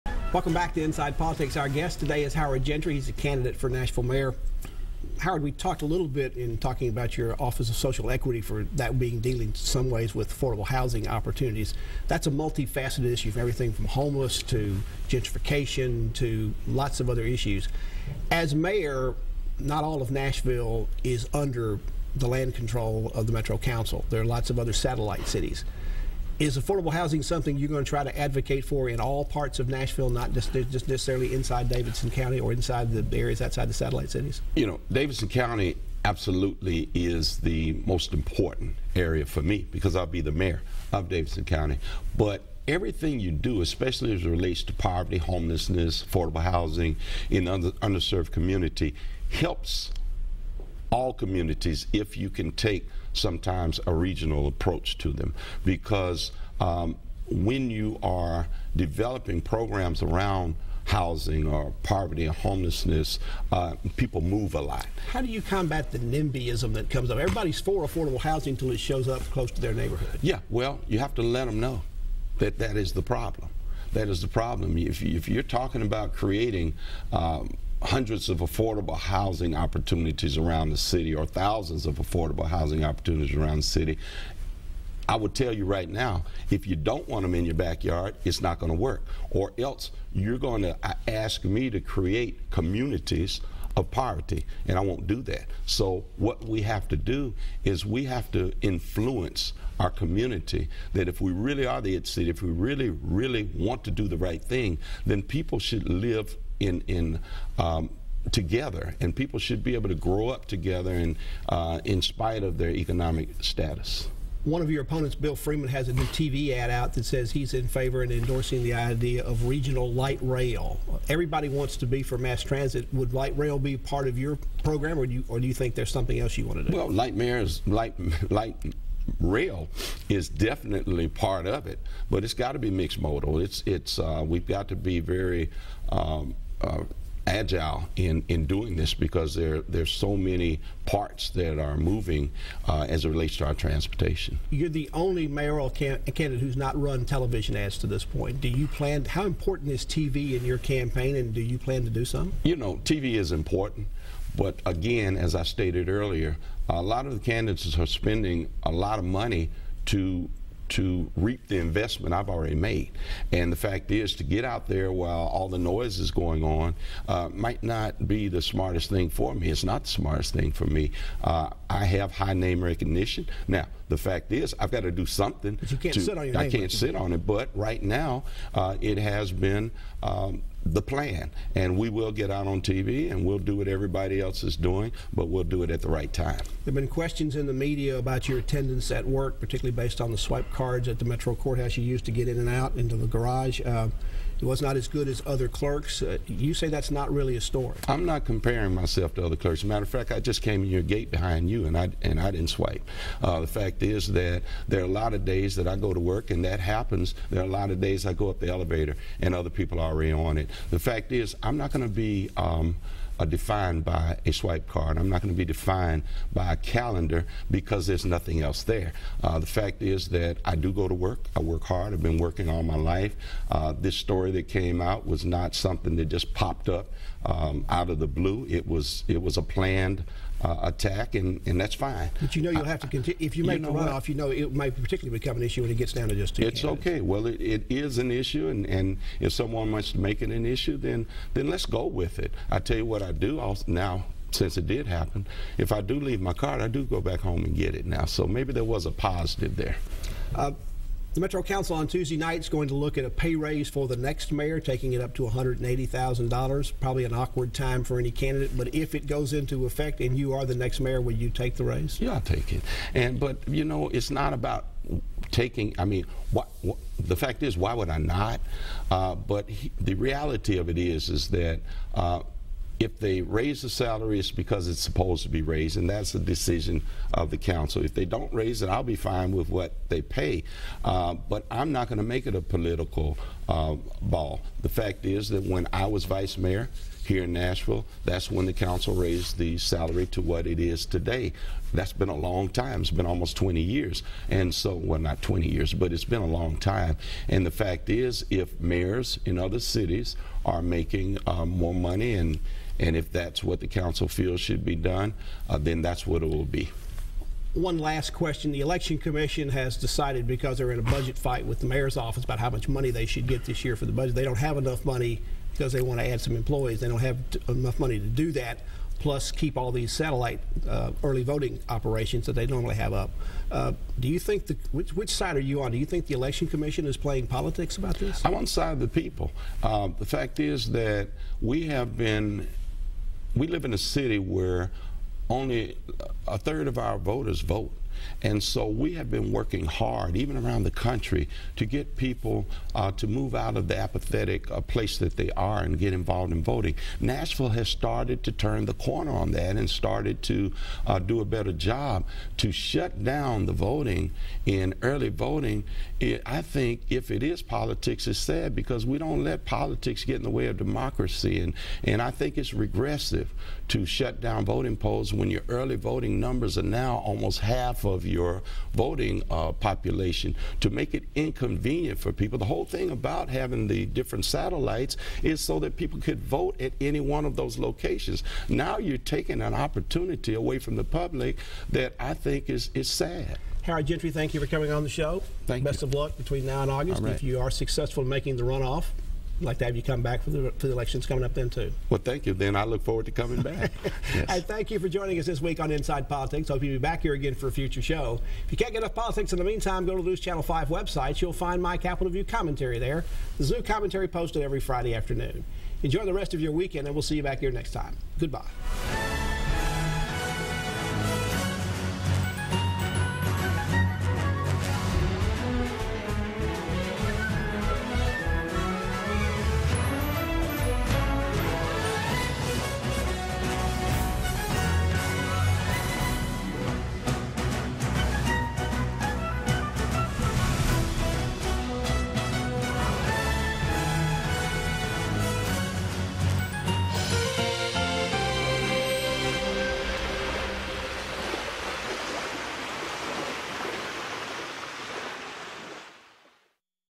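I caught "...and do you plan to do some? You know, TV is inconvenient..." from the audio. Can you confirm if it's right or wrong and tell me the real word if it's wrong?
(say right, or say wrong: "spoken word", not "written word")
wrong: "important", not "inconvenient".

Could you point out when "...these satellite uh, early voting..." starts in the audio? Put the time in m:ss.
5:19.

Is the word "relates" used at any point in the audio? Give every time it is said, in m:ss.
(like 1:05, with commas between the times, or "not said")
0:44, 2:23.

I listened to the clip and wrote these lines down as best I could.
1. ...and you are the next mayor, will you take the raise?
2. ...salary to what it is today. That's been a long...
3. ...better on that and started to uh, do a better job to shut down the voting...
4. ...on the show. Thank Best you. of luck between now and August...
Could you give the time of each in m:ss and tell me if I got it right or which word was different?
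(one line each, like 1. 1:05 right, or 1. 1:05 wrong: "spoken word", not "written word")
1. 4:19 right
2. 4:49 right
3. 5:48 wrong: "corner", not "better"
4. 6:24 right.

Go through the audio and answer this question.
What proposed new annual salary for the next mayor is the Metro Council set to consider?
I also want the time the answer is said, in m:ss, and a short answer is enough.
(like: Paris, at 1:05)
$180,000, at 4:15.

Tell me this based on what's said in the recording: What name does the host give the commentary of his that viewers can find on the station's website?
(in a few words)
Capitol View.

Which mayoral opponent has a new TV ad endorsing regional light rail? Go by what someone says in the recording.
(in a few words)
Bill Freeman.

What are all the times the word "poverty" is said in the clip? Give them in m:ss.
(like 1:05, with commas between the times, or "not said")
0:44, 1:01, 1:33.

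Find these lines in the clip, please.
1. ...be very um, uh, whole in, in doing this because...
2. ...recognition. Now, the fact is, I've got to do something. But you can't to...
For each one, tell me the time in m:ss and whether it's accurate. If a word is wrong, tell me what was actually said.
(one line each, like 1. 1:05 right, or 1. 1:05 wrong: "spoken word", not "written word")
1. 2:14 wrong: "agile", not "whole"
2. 2:52 right.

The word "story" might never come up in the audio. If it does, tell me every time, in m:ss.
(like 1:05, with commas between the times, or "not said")
3:17, 3:43.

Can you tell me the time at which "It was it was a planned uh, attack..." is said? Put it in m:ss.
3:48.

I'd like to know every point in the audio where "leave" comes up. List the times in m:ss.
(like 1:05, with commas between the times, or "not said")
4:05.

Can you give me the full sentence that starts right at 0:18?
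As mayor, not all of Nashville is under the land control of the Metro Council.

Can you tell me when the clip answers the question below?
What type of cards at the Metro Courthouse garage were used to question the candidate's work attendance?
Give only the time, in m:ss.
3:10.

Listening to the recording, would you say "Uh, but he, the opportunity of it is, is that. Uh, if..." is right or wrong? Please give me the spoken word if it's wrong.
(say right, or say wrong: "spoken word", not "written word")
wrong: "reality", not "opportunity".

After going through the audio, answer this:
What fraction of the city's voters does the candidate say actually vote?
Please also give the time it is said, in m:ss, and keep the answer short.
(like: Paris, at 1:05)
a third, at 5:36.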